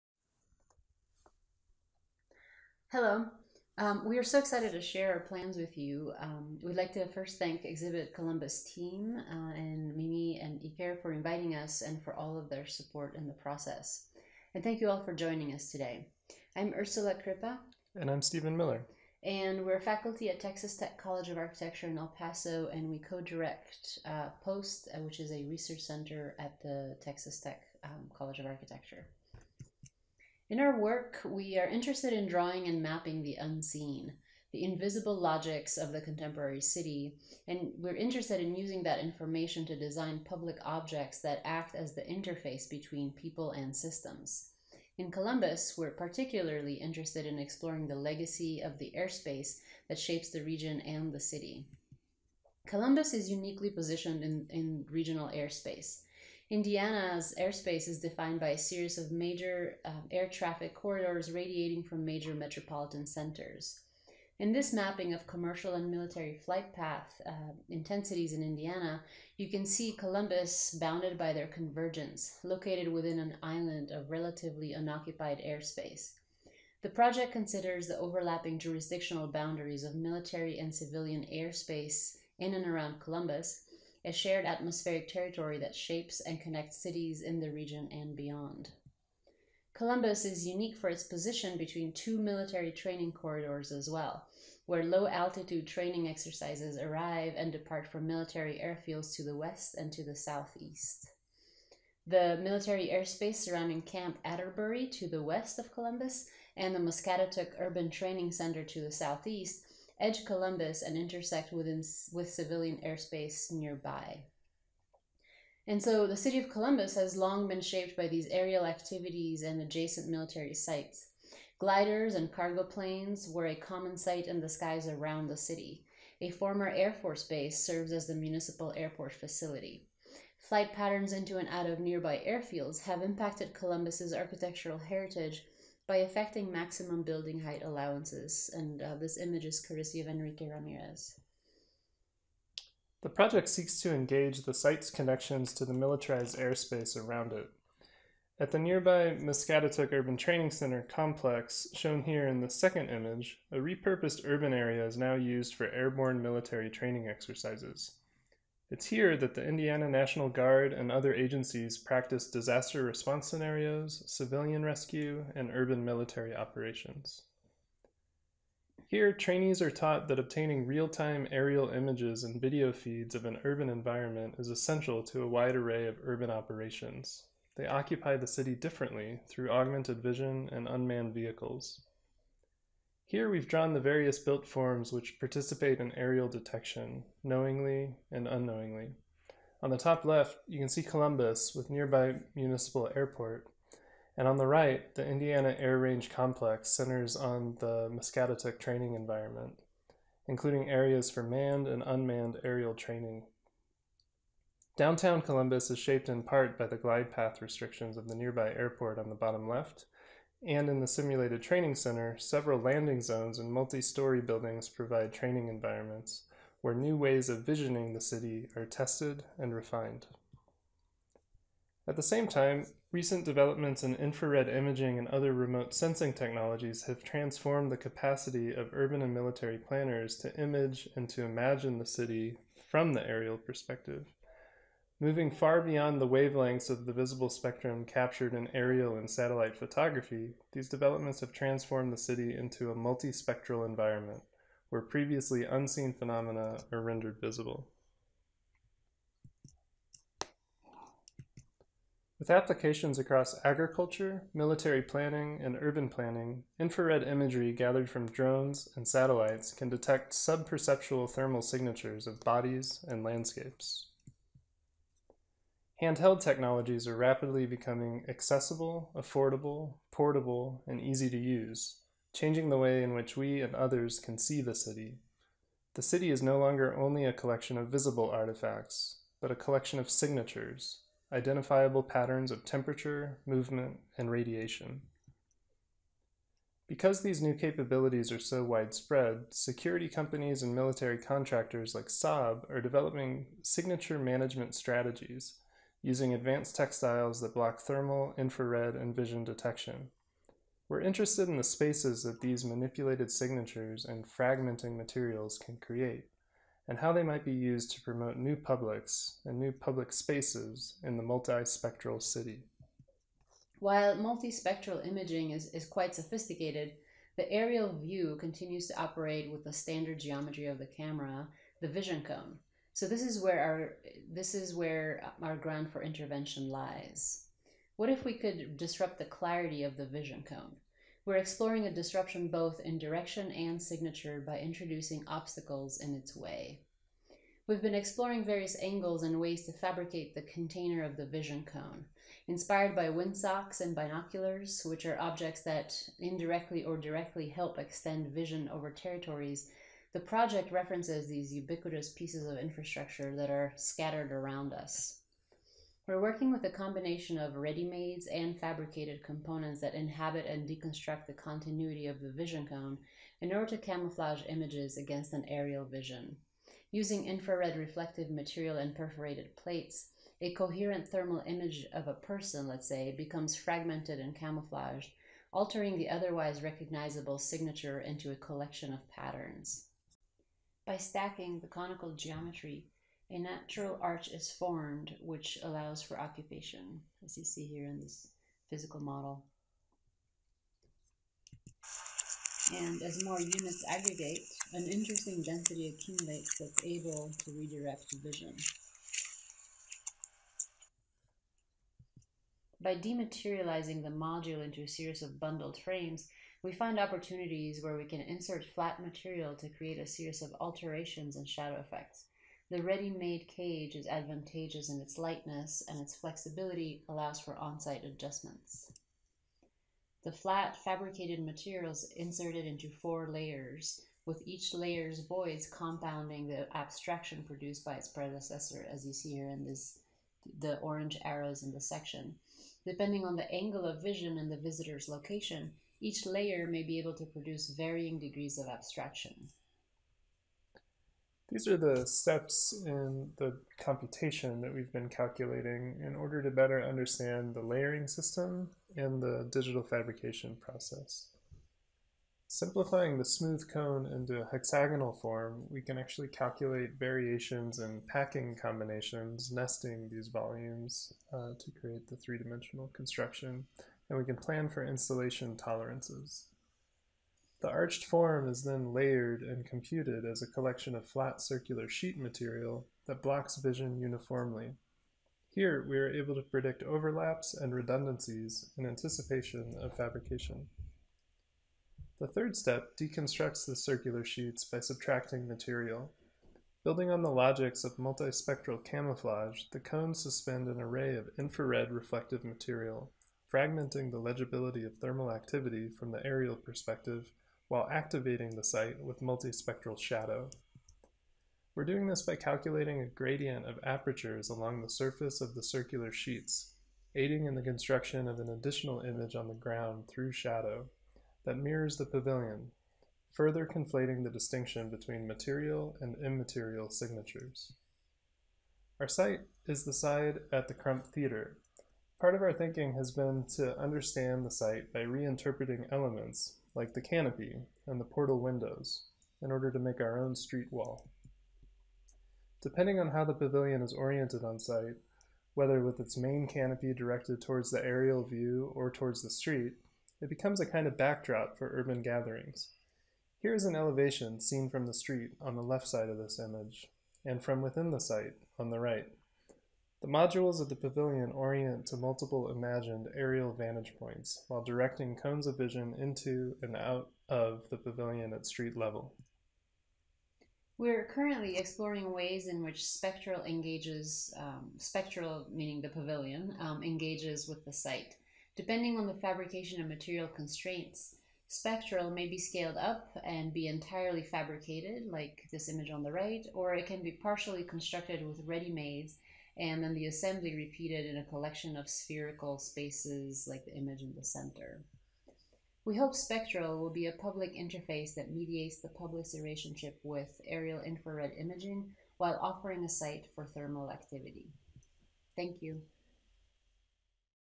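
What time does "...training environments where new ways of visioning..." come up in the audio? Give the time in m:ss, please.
3:35.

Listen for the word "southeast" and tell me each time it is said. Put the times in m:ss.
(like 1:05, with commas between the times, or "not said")
1:40, 1:48.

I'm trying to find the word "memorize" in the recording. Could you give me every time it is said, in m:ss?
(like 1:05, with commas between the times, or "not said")
not said.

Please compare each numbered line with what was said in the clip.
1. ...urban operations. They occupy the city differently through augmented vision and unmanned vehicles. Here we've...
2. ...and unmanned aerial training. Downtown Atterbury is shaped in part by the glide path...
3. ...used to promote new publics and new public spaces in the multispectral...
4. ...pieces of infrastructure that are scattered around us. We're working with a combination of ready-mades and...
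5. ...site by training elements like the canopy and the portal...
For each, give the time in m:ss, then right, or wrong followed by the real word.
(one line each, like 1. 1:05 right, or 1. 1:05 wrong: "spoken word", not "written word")
1. 2:56 right
2. 3:21 wrong: "Columbus", not "Atterbury"
3. 5:07 right
4. 5:51 right
5. 8:44 wrong: "reinterpreting", not "training".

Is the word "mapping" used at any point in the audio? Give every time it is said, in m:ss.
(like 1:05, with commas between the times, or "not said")
0:32, 1:04.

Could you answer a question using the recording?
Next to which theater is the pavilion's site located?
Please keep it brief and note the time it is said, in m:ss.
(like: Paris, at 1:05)
Crump Theater, at 8:40.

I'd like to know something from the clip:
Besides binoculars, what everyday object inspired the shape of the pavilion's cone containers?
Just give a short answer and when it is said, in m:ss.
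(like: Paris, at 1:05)
windsocks, at 5:42.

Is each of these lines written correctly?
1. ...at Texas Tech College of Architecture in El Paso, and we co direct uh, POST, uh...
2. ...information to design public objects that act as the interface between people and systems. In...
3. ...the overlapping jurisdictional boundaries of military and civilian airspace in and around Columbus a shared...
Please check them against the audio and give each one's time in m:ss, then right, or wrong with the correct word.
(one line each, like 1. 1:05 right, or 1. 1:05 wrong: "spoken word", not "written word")
1. 0:20 right
2. 0:38 right
3. 1:17 right.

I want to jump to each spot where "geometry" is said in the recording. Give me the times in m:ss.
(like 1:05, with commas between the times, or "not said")
5:19, 6:21.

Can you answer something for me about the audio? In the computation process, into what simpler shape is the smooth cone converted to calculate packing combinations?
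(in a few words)
hexagonal form.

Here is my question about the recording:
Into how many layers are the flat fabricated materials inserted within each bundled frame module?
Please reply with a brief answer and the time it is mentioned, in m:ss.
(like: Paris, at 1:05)
4, at 7:02.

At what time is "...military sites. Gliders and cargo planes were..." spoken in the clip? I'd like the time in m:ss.
2:00.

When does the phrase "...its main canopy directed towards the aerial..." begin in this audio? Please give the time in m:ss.
8:55.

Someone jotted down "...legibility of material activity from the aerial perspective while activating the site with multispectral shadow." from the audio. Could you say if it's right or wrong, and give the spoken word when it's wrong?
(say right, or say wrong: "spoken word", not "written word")
wrong: "thermal", not "material".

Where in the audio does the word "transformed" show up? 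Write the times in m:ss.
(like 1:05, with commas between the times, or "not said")
3:47, 4:01.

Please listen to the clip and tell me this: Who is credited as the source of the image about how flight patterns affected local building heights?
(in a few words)
Enrique Ramirez.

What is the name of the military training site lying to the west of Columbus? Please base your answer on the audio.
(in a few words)
Camp Atterbury.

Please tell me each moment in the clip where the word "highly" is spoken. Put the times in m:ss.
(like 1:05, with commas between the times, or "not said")
not said.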